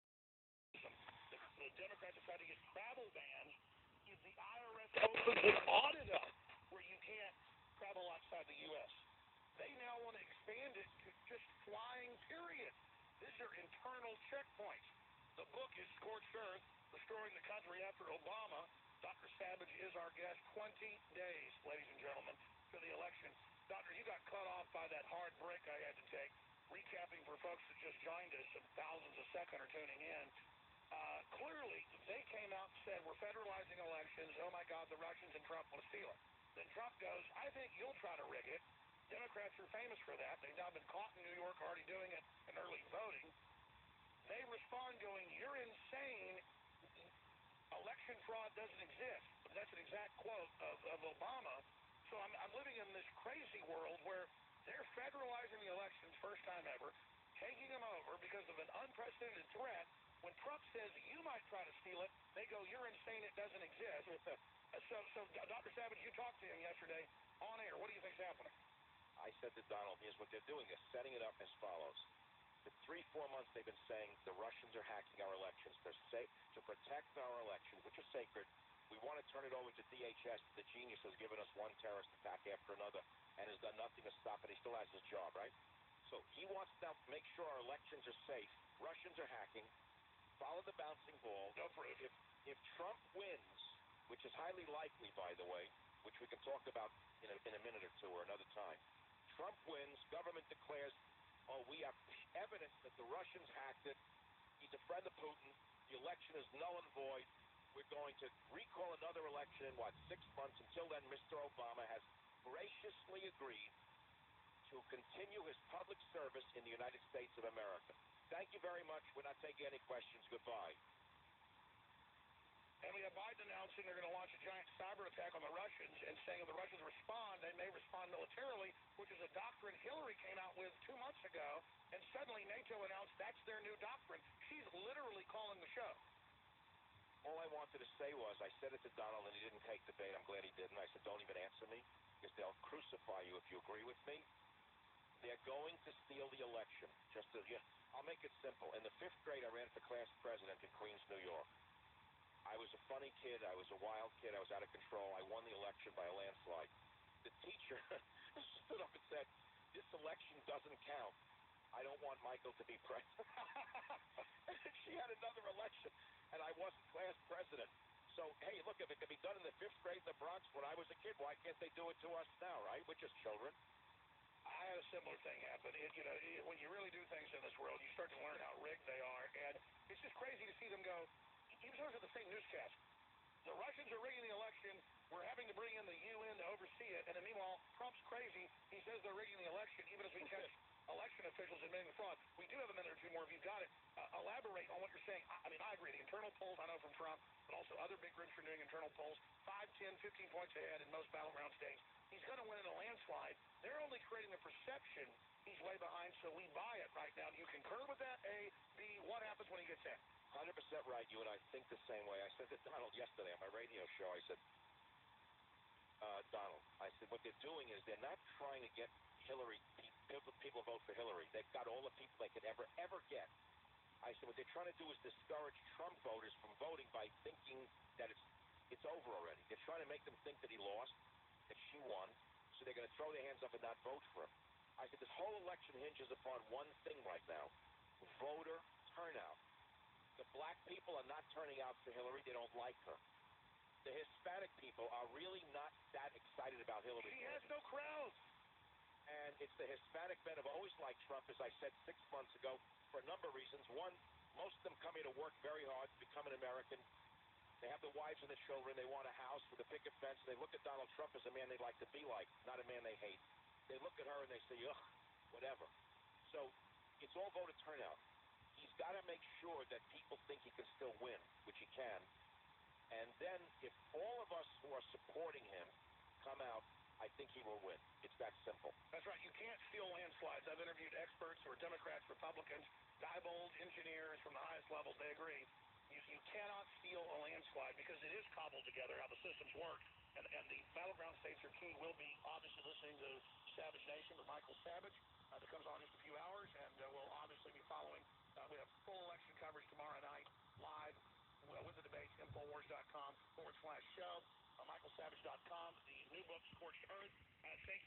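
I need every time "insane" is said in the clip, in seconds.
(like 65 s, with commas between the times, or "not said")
45 s, 62 s.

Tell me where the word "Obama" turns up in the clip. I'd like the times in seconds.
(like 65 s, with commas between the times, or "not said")
18 s, 51 s, 111 s.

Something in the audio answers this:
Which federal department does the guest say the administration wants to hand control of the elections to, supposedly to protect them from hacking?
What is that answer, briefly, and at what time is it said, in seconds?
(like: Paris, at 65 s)
DHS, at 79 s.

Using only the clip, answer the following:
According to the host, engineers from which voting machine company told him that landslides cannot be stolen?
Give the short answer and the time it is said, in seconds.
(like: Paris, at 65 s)
Diebold, at 283 s.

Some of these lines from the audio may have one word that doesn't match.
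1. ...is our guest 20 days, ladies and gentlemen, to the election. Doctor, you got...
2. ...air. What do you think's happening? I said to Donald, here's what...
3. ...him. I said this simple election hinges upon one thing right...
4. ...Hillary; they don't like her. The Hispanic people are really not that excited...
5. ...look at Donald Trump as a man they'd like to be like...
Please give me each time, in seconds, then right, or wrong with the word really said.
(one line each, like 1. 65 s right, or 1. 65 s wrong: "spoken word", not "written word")
1. 19 s right
2. 67 s right
3. 234 s wrong: "whole", not "simple"
4. 241 s right
5. 260 s right.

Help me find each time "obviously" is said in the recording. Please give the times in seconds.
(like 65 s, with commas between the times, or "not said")
292 s, 297 s.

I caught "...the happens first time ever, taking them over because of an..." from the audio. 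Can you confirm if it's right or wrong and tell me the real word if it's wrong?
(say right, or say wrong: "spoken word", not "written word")
wrong: "elections", not "happens".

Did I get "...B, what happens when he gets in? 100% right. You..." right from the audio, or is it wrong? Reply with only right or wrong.
right.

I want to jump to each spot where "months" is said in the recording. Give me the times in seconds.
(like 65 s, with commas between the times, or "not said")
73 s, 110 s, 130 s, 252 s.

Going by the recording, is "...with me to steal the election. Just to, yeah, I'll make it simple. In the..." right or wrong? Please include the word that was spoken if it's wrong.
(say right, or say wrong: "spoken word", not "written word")
right.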